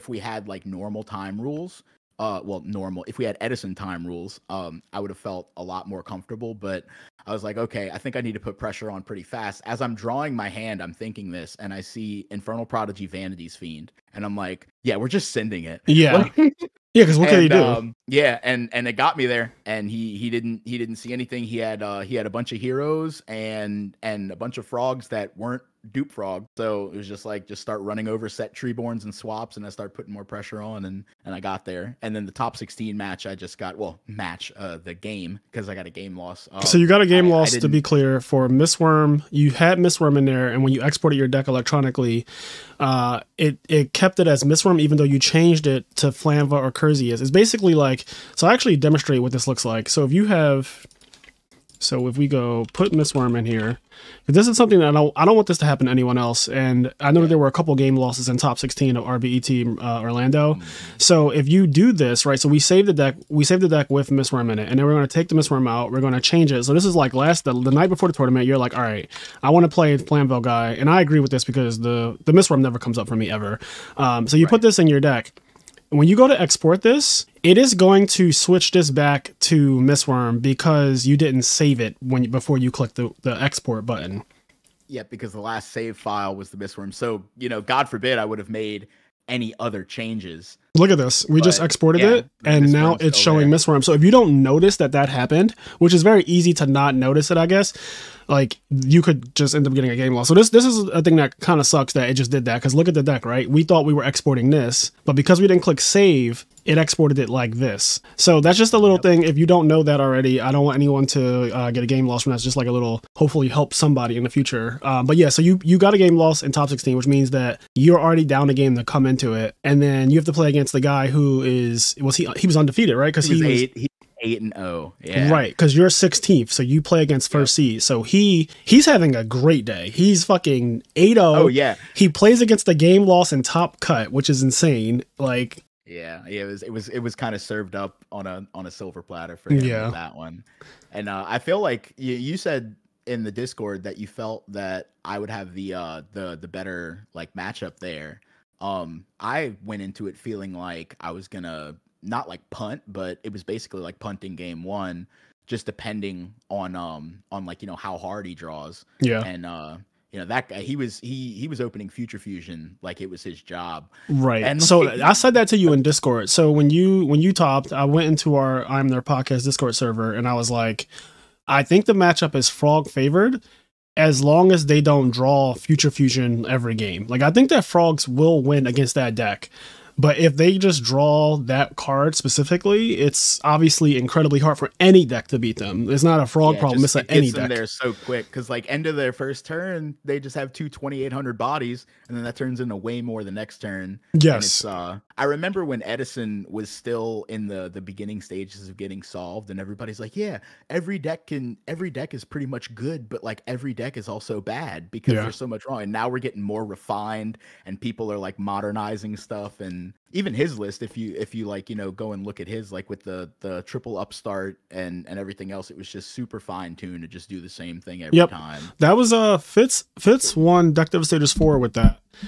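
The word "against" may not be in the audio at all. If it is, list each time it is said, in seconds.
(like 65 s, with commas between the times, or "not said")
120 s, 127 s, 132 s, 178 s.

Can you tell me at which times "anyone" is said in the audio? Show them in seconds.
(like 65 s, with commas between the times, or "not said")
55 s, 110 s.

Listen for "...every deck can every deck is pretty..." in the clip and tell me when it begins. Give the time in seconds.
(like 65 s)
200 s.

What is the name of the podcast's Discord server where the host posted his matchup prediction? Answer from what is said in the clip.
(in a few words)
IMNerd.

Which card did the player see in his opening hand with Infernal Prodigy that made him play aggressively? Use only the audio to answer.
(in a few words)
Vanities Fiend.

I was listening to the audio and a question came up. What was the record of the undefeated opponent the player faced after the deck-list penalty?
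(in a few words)
8-0.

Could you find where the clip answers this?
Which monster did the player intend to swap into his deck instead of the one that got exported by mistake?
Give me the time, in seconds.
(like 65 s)
46 s.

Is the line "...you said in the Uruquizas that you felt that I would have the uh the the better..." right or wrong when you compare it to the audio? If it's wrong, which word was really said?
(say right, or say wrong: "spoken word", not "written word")
wrong: "Discord", not "Uruquizas".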